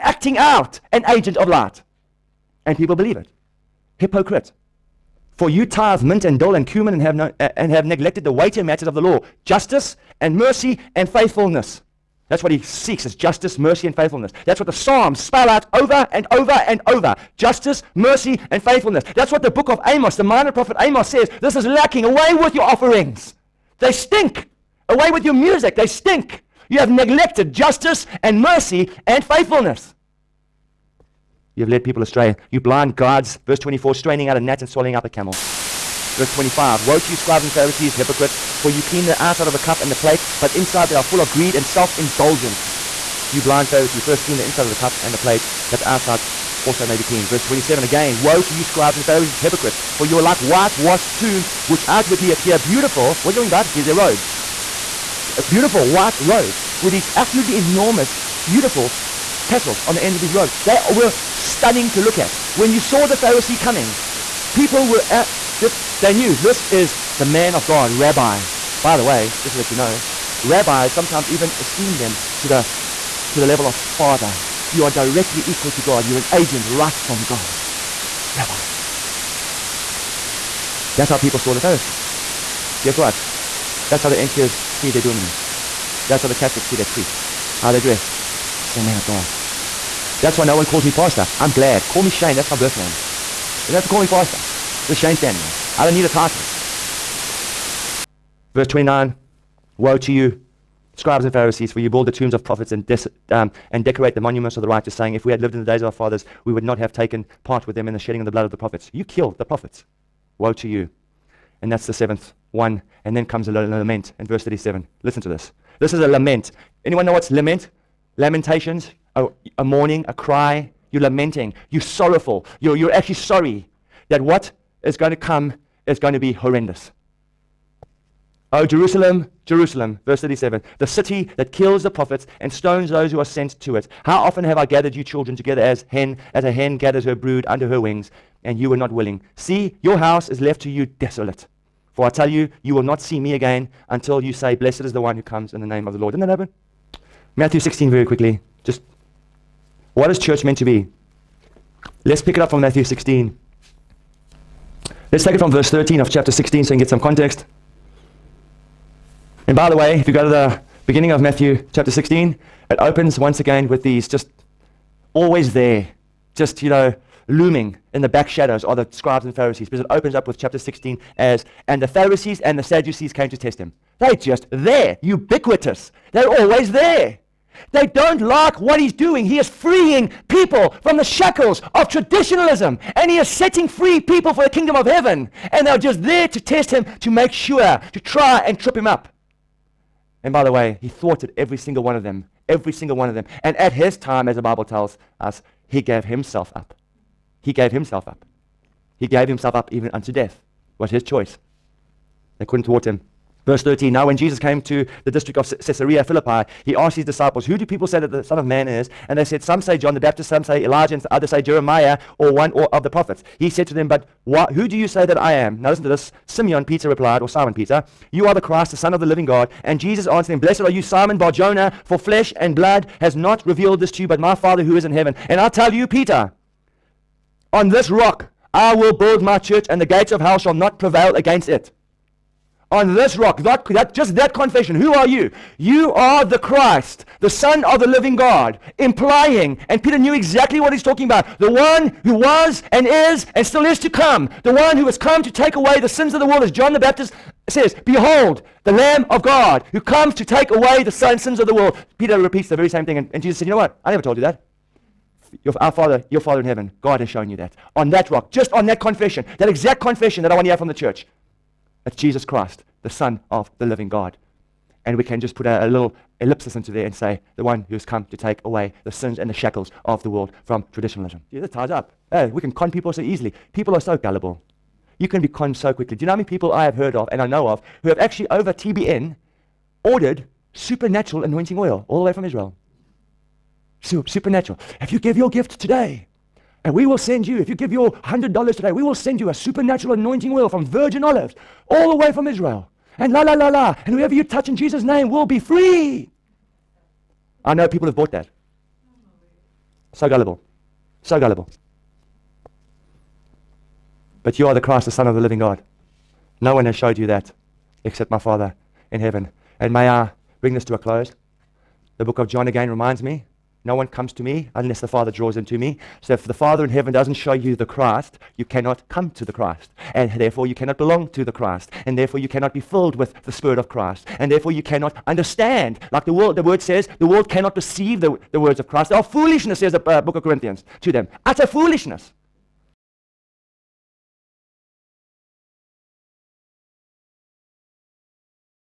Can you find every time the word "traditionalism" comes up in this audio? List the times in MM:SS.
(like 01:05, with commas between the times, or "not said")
03:01, 04:30.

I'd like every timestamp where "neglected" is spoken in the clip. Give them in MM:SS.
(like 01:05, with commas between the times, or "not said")
00:07, 00:26.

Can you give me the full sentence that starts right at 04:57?
I know people have bought that.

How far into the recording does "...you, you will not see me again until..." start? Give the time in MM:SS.
02:22.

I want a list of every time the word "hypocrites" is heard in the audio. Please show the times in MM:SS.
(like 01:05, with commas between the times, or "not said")
00:03, 00:37, 00:49.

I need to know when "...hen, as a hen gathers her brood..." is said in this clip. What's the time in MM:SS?
02:15.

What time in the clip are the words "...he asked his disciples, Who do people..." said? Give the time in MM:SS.
03:26.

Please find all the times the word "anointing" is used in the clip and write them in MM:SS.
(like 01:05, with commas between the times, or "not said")
04:41, 04:49.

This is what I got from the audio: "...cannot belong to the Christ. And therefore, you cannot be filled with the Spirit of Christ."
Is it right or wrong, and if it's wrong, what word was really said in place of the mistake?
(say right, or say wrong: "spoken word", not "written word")
right.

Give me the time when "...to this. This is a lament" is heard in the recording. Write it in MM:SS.
01:55.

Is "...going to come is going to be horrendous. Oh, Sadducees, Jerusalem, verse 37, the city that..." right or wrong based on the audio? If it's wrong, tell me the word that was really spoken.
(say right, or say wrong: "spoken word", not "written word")
wrong: "Jerusalem", not "Sadducees".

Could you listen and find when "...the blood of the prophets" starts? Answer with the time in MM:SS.
01:48.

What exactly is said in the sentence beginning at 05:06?
No one has showed you that except my Father in heaven.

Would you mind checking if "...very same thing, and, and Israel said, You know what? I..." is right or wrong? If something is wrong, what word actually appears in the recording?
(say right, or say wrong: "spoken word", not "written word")
wrong: "Jesus", not "Israel".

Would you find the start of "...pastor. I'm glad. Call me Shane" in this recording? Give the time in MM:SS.
01:30.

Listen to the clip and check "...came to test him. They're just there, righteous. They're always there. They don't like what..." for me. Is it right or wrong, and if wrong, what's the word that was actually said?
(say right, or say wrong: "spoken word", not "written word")
wrong: "ubiquitous", not "righteous".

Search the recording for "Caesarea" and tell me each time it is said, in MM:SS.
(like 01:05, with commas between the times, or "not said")
03:25.